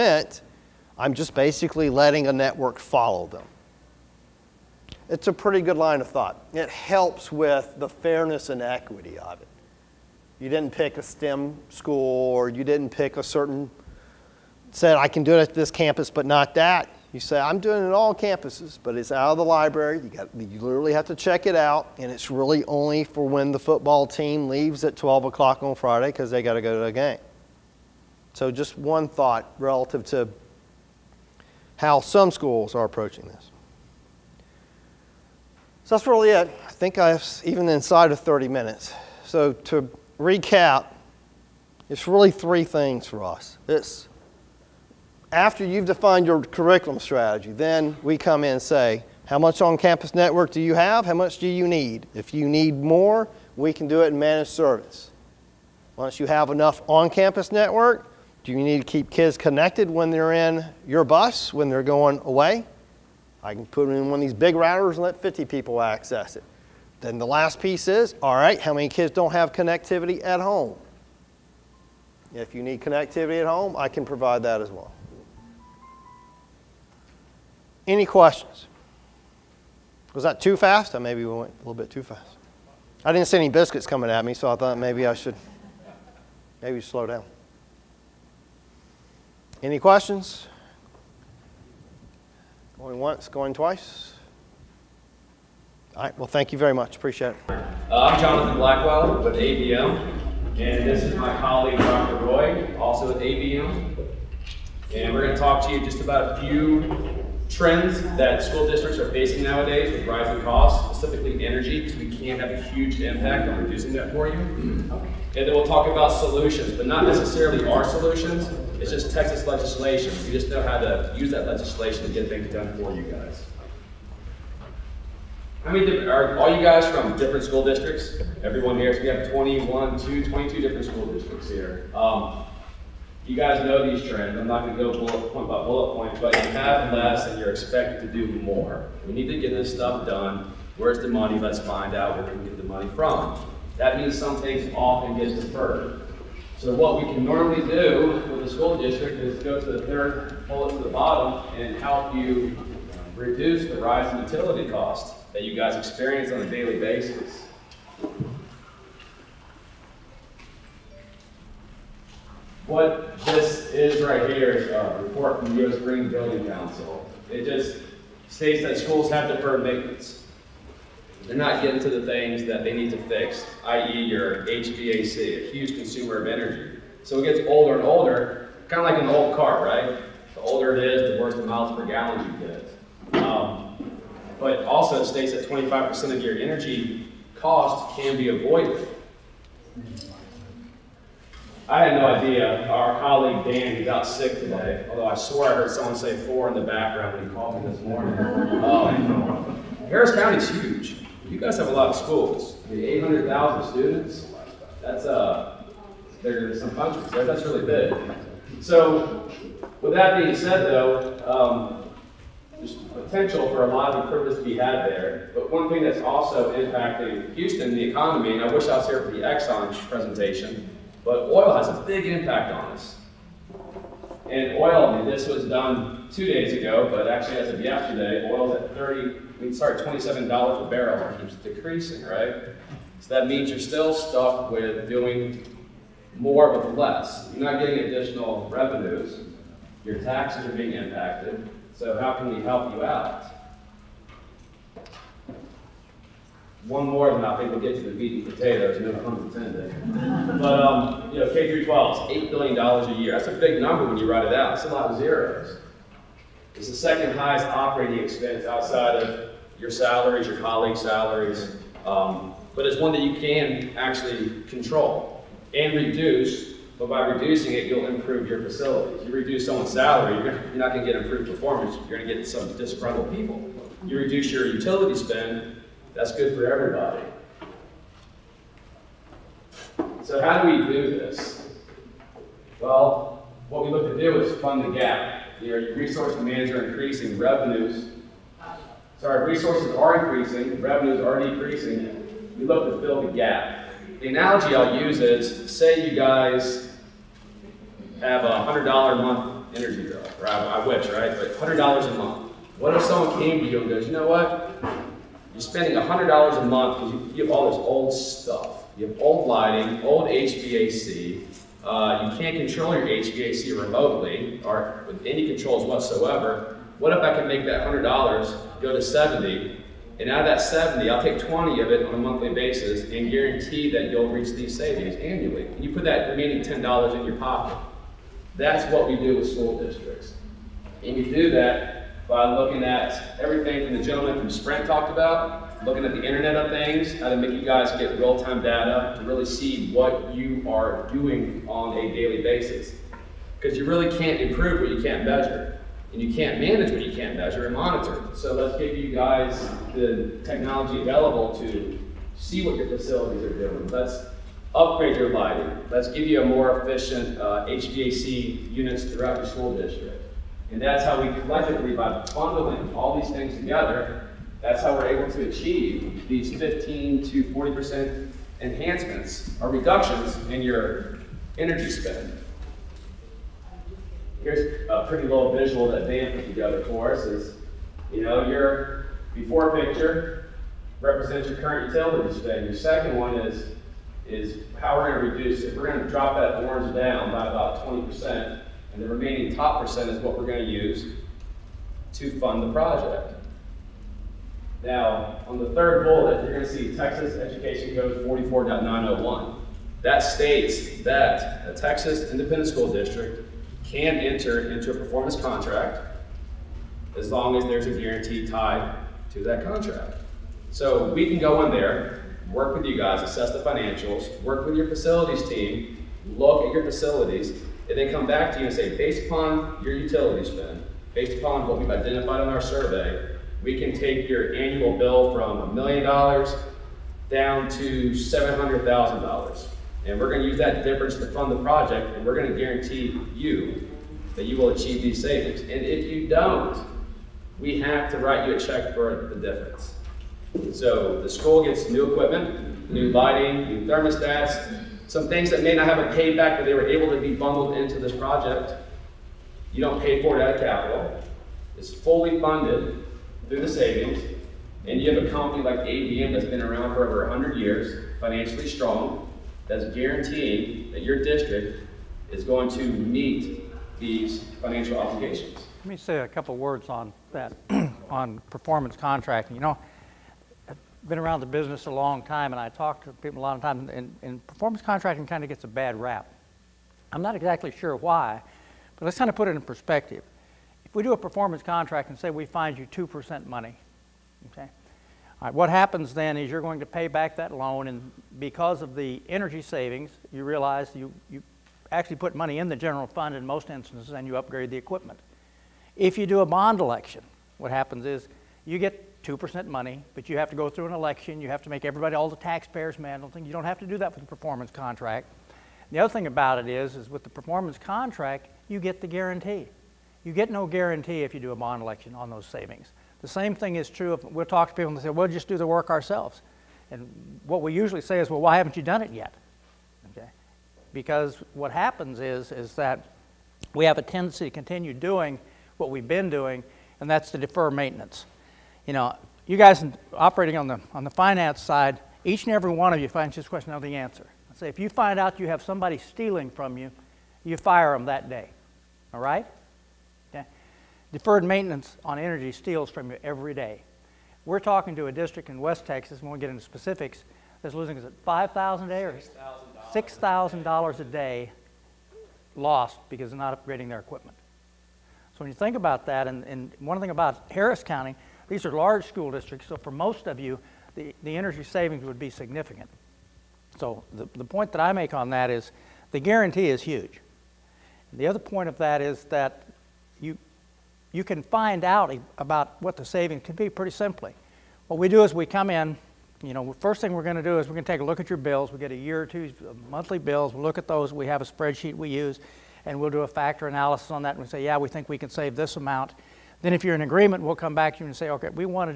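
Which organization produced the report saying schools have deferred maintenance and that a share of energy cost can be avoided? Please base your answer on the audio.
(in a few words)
U.S. Green Building Council.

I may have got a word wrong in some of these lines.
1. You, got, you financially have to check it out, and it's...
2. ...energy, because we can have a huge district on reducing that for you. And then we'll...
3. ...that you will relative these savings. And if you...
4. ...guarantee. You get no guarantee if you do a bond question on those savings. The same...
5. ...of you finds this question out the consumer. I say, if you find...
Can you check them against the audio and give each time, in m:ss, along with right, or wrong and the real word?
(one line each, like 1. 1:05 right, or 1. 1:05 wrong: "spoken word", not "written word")
1. 0:19 wrong: "literally", not "financially"
2. 1:51 wrong: "impact", not "district"
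3. 7:14 wrong: "achieve", not "relative"
4. 8:28 wrong: "election", not "question"
5. 8:52 wrong: "answer", not "consumer".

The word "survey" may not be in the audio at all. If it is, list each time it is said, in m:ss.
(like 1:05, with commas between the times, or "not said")
7:02.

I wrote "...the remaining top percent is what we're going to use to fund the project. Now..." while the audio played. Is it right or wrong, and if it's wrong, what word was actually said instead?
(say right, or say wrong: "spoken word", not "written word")
right.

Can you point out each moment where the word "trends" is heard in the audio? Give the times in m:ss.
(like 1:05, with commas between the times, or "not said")
1:47, 2:14.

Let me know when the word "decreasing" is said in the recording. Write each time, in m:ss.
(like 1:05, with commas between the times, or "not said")
3:51, 4:51.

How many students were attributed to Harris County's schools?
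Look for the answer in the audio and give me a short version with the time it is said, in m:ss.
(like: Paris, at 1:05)
800,000, at 3:22.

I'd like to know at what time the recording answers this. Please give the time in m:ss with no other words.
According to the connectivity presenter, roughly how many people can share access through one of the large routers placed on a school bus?
1:05.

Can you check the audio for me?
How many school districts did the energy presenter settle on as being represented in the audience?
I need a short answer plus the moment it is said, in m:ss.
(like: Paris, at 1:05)
22, at 2:10.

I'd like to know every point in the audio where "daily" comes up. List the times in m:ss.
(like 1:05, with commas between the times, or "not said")
2:36, 5:41.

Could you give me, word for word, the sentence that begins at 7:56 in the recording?
I'm not exactly sure why, but let's kind of put it in perspective.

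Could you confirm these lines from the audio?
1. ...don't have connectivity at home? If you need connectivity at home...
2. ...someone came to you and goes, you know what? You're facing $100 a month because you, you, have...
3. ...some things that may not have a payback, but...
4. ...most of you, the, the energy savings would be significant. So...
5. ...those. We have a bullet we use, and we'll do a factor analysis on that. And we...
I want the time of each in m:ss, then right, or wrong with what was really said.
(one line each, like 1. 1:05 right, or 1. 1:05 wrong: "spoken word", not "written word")
1. 1:09 right
2. 5:02 wrong: "spending", not "facing"
3. 7:24 right
4. 9:19 right
5. 9:40 wrong: "spreadsheet", not "bullet".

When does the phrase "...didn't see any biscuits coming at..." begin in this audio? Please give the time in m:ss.
1:23.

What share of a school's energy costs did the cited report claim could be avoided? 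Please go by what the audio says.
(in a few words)
25%.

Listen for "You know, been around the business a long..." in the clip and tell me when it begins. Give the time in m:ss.
7:49.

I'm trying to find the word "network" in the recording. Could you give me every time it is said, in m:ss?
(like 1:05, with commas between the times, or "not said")
0:02, 0:50, 0:57.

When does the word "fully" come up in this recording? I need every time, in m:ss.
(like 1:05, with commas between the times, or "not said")
7:31.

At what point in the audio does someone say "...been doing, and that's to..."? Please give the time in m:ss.
8:45.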